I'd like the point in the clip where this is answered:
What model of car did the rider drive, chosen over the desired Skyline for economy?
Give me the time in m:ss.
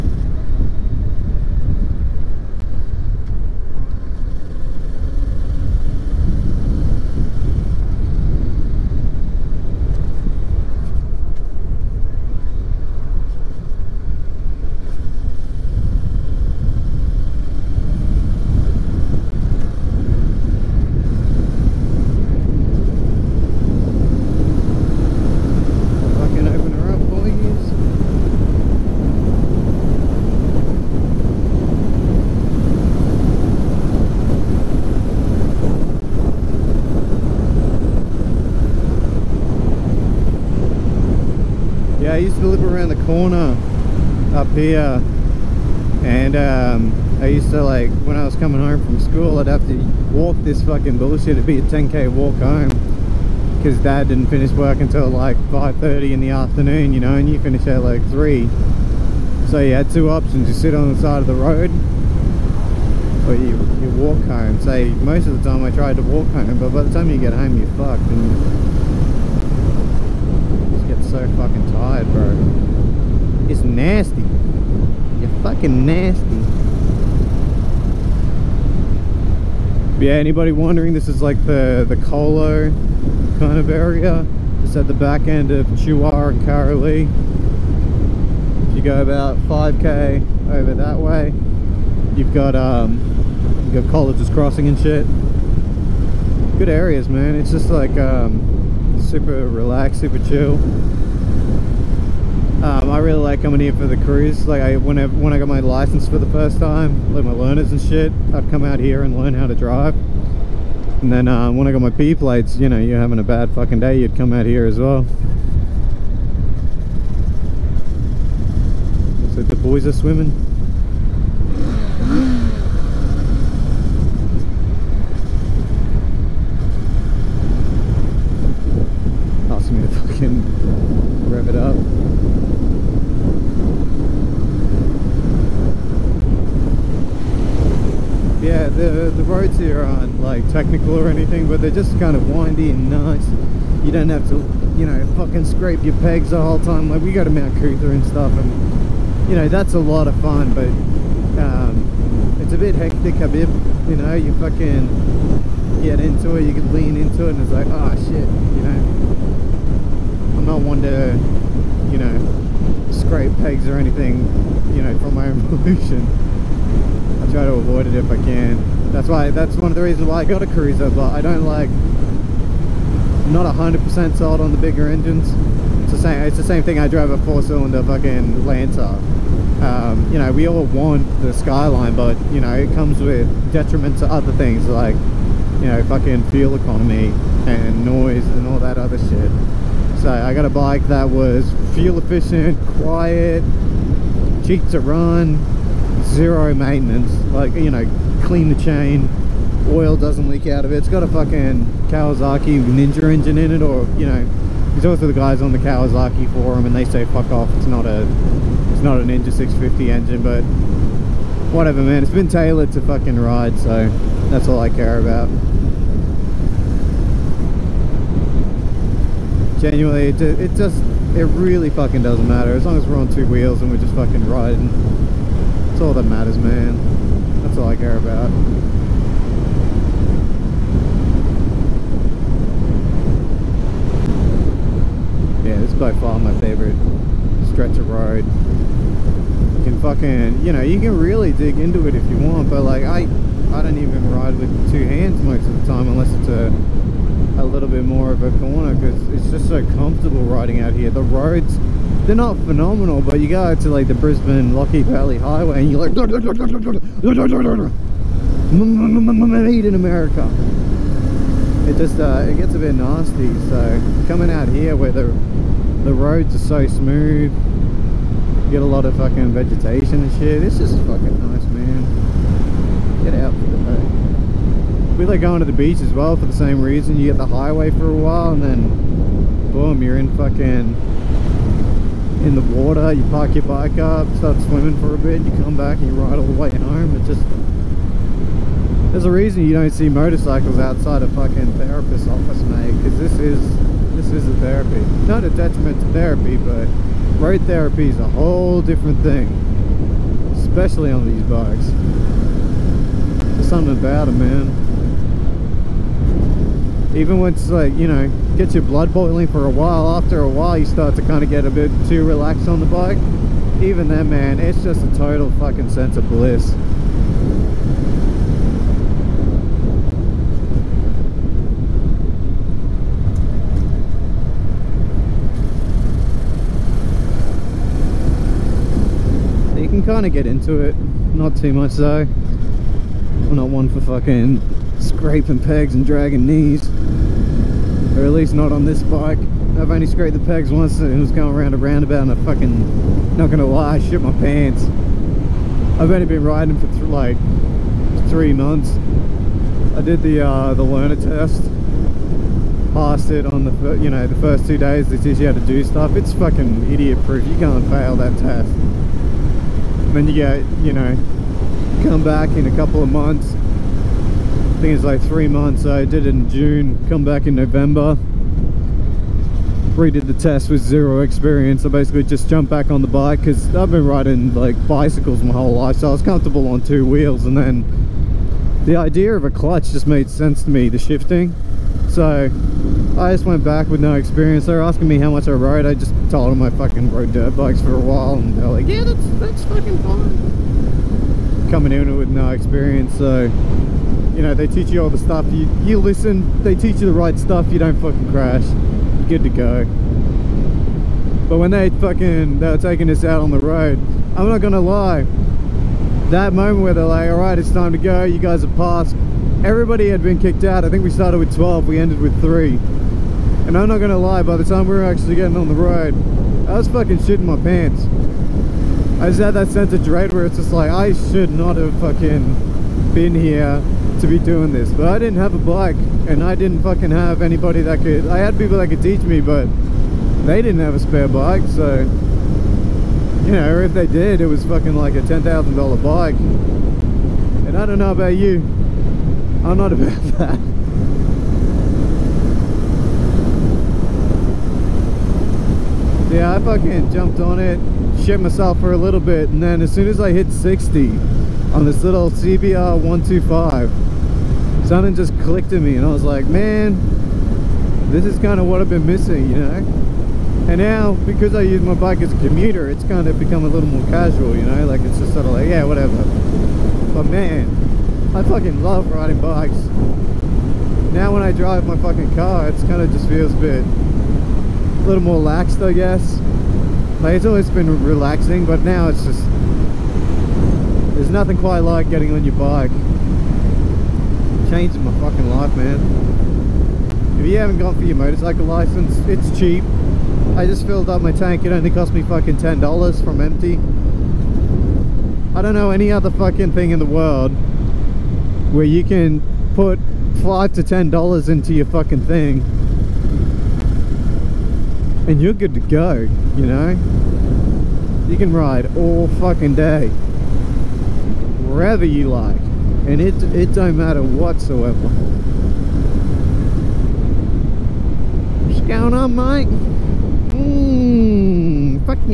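2:58.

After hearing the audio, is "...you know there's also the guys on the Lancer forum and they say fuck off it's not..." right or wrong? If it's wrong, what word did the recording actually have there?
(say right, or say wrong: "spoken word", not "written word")
wrong: "Kawasaki", not "Lancer".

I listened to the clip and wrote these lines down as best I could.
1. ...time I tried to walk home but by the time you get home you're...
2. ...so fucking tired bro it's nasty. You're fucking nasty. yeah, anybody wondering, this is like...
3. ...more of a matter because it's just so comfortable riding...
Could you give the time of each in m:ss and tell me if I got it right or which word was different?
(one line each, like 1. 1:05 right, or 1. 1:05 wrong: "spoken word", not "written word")
1. 1:05 right
2. 1:11 right
3. 4:07 wrong: "corner", not "matter".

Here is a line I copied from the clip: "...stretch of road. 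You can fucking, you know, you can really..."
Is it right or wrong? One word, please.
right.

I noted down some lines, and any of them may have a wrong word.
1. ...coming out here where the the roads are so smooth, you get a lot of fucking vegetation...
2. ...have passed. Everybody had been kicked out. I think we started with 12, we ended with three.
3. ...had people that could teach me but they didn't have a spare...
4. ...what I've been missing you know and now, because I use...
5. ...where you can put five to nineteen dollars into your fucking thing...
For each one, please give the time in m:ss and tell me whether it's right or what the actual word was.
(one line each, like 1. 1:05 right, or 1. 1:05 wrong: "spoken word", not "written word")
1. 4:24 right
2. 6:48 right
3. 7:08 right
4. 7:38 right
5. 8:18 wrong: "ten", not "nineteen".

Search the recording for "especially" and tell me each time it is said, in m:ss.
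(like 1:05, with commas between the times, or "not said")
5:00.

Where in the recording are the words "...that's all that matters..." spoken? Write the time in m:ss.
3:45.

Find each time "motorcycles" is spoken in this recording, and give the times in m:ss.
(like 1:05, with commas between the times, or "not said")
4:49, 8:07.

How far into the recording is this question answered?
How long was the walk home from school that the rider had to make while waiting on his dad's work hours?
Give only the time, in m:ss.
0:51.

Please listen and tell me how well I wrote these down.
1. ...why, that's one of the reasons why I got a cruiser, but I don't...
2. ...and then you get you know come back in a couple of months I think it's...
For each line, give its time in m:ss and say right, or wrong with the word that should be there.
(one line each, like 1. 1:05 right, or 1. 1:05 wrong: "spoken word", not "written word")
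1. 2:49 right
2. 5:58 right.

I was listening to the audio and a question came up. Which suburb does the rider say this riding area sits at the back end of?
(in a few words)
Chuwar.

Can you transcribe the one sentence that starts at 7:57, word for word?
Like, it's always been relaxing, but now it's just...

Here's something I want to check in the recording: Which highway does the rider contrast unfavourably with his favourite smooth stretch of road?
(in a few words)
Brisbane Lockyer Valley Highway.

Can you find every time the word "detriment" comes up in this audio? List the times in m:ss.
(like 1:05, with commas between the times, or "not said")
3:03, 4:55.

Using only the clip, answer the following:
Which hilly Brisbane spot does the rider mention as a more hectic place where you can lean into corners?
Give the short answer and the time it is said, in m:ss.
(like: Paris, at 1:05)
Mount Coot-tha, at 2:27.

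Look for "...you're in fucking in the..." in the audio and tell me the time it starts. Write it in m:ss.
4:39.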